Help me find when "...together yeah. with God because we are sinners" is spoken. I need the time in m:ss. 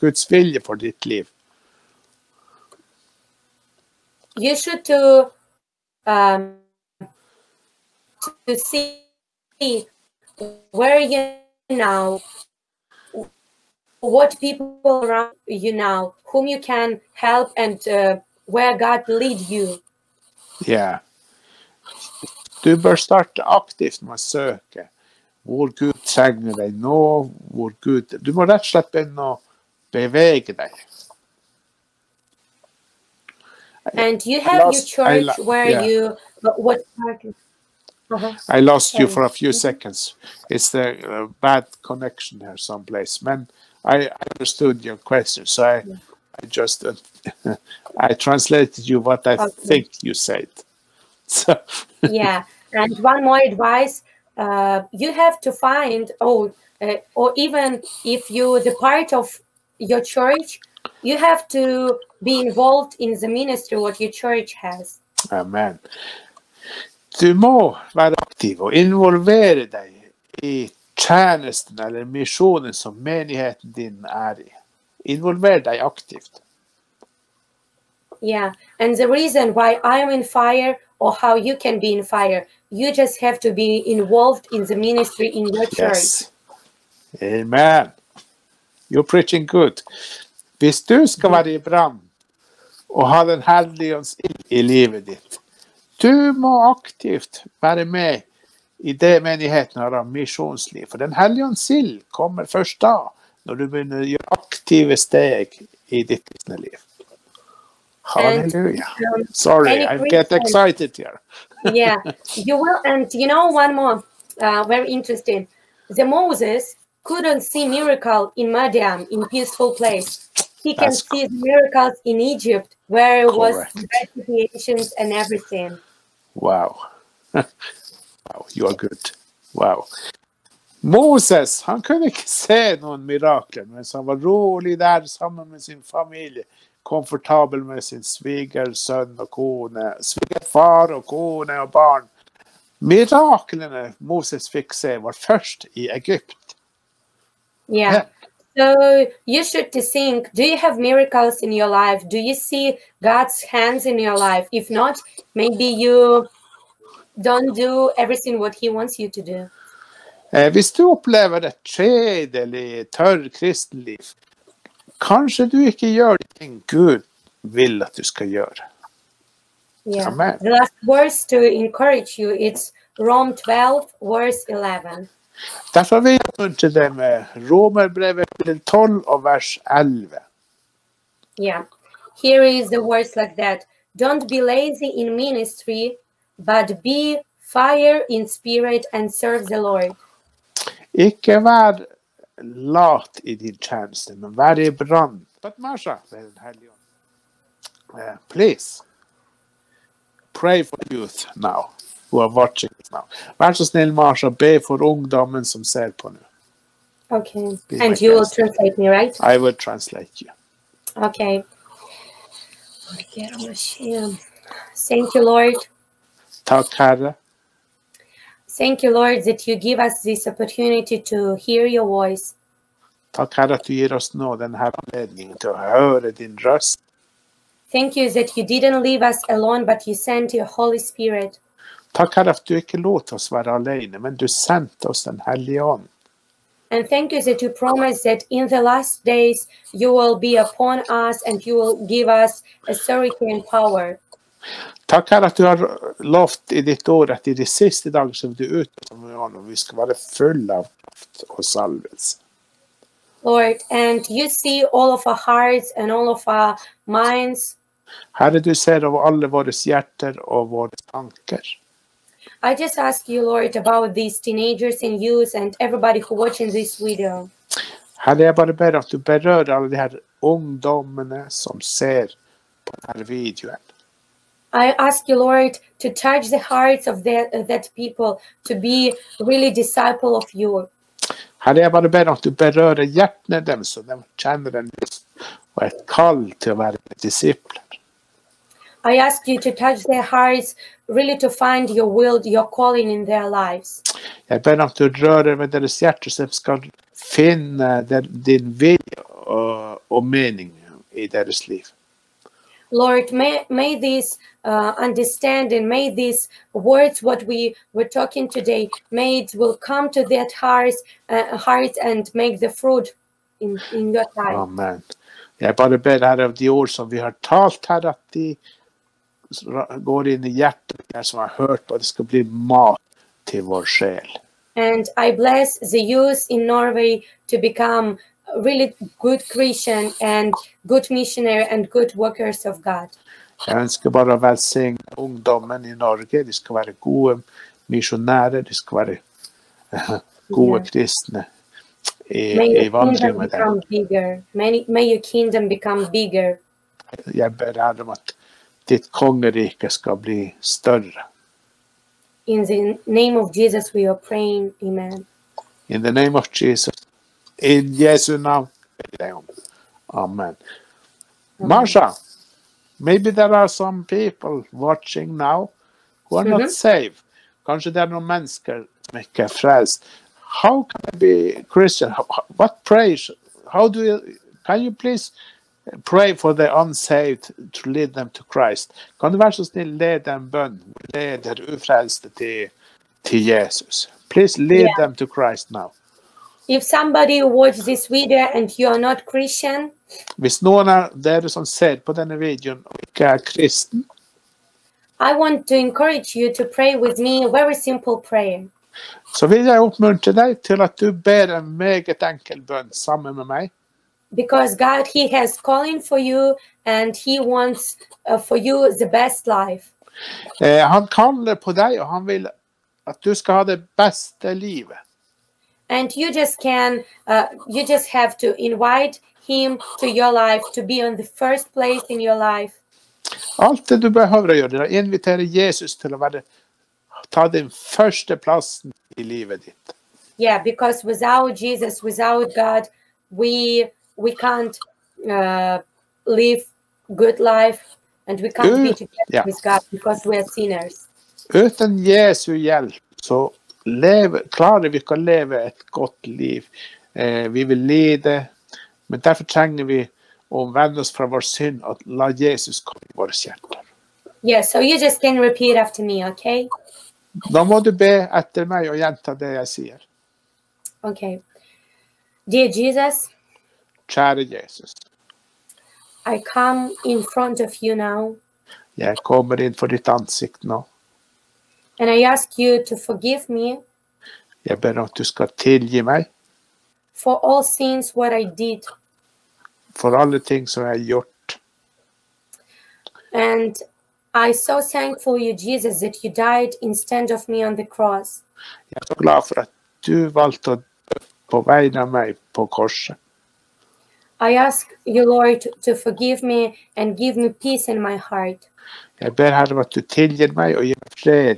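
7:18.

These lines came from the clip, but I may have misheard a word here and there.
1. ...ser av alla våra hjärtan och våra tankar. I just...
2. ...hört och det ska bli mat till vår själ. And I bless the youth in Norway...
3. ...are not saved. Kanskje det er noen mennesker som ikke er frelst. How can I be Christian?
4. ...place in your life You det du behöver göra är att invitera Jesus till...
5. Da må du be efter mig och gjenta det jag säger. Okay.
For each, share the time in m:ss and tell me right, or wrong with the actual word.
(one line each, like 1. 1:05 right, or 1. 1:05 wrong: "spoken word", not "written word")
1. 4:18 right
2. 5:21 right
3. 6:06 right
4. 7:01 wrong: "Allt", not "You"
5. 7:37 right.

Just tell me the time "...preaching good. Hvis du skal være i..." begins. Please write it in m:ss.
1:29.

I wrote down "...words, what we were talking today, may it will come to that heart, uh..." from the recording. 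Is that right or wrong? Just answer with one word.
right.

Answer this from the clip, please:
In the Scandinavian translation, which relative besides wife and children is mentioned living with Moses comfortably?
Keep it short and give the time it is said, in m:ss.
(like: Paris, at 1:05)
svigerfar, at 2:20.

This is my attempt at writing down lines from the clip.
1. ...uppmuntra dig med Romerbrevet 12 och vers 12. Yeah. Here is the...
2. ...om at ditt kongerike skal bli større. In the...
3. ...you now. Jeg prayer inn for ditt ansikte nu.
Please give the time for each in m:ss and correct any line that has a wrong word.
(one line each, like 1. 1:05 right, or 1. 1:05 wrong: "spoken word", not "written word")
1. 2:56 wrong: "11", not "12"
2. 5:47 right
3. 7:47 wrong: "kommer", not "prayer".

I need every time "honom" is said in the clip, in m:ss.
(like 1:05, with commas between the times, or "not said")
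4:09.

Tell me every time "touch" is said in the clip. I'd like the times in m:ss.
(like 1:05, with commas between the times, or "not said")
4:35, 4:49.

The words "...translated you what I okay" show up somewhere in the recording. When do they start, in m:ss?
0:48.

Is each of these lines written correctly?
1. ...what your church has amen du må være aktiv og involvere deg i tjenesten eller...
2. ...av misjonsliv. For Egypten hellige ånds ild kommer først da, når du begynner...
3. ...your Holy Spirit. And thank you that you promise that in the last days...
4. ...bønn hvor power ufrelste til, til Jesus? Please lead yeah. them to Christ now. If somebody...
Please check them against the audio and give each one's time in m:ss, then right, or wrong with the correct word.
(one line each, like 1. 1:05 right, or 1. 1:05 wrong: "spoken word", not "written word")
1. 1:03 right
2. 1:39 wrong: "Den", not "Egypten"
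3. 3:50 right
4. 6:20 wrong: "leder", not "power".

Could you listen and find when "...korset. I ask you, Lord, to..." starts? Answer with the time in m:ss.
8:12.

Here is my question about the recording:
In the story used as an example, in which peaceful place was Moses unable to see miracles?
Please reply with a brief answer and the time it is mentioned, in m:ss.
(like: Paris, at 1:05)
Madian, at 1:58.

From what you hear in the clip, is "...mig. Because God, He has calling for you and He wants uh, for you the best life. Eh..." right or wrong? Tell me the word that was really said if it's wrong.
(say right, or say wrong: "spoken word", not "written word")
right.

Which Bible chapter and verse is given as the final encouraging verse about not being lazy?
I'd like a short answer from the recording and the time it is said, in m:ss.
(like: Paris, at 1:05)
Romans 12:11, at 2:52.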